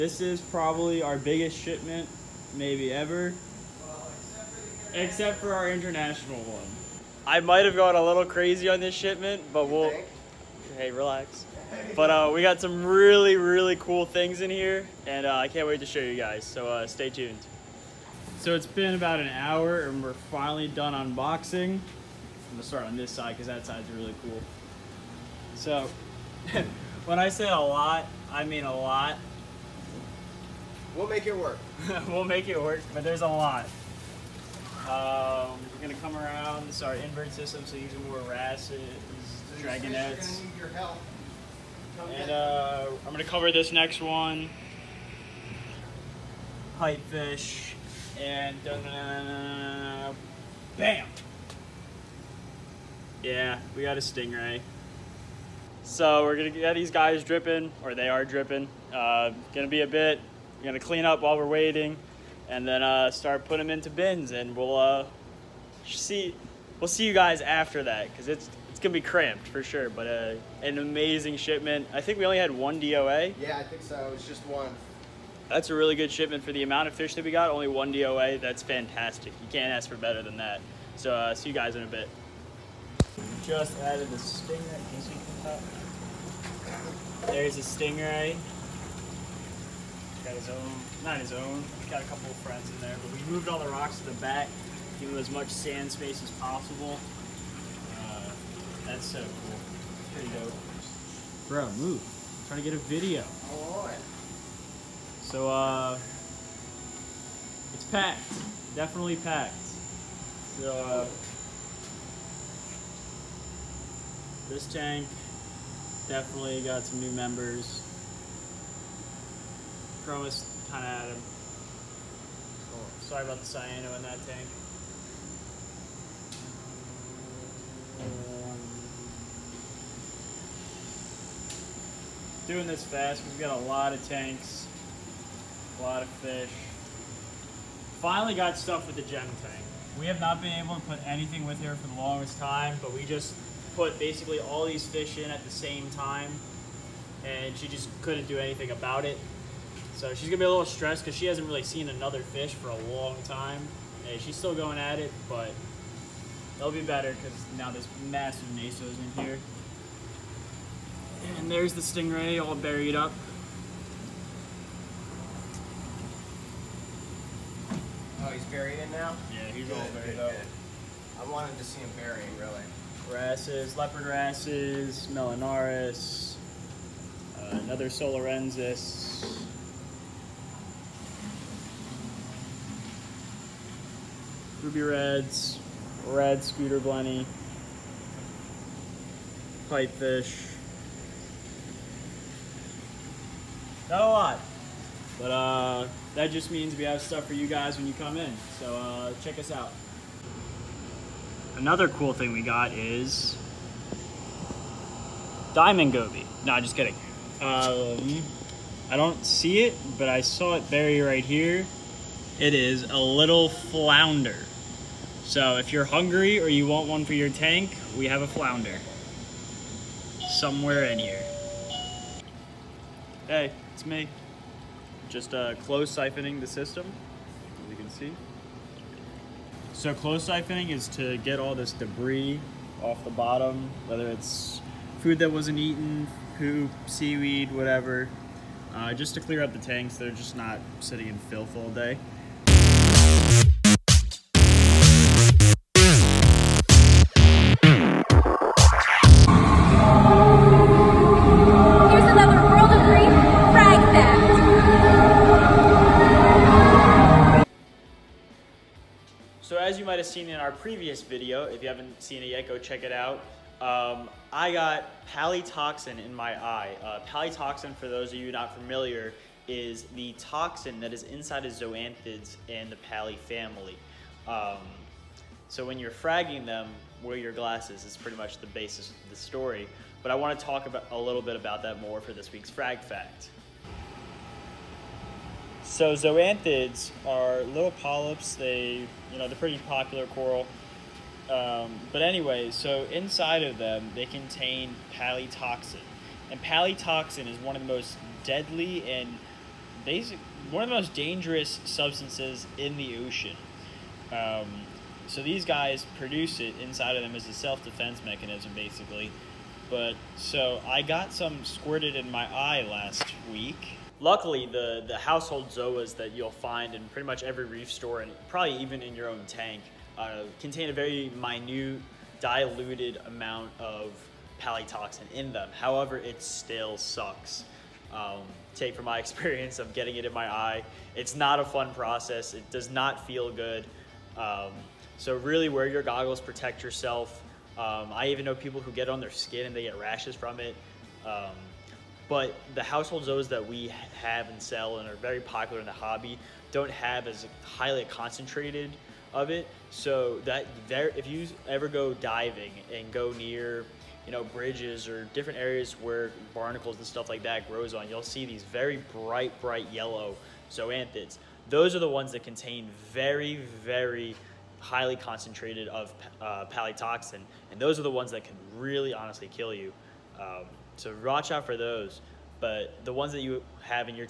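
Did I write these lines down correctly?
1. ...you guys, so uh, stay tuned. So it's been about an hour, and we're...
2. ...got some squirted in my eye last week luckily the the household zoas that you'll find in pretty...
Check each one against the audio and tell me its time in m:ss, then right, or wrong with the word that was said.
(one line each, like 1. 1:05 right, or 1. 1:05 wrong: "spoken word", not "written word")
1. 0:16 right
2. 5:10 right.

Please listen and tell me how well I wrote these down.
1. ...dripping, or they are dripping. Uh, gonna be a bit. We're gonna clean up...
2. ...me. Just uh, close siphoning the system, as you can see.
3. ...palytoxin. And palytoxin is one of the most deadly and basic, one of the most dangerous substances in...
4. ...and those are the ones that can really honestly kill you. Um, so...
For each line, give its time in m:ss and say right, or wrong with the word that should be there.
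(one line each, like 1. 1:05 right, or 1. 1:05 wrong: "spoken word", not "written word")
1. 0:57 right
2. 3:43 right
3. 4:54 right
4. 6:07 right.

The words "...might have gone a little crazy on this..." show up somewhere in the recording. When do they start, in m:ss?
0:07.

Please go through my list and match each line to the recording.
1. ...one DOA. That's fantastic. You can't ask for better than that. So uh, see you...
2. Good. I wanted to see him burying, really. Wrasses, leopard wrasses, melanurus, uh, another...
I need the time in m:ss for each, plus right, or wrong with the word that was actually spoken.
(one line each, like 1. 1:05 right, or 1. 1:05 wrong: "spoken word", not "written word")
1. 1:17 right
2. 2:50 right.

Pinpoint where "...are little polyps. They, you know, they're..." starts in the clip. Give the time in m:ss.
4:47.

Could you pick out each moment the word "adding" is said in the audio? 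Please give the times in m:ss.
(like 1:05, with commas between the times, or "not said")
not said.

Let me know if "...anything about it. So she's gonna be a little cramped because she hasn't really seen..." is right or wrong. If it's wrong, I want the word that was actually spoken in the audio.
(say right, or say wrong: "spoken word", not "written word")
wrong: "stressed", not "cramped".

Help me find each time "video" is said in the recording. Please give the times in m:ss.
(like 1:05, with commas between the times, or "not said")
1:42, 4:21.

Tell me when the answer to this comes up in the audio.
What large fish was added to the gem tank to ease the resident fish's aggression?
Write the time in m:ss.
2:38.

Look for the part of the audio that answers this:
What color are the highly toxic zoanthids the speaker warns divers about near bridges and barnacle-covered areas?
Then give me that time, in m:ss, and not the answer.
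5:58.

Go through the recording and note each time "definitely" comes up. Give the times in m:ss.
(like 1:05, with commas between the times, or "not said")
1:48, 1:56.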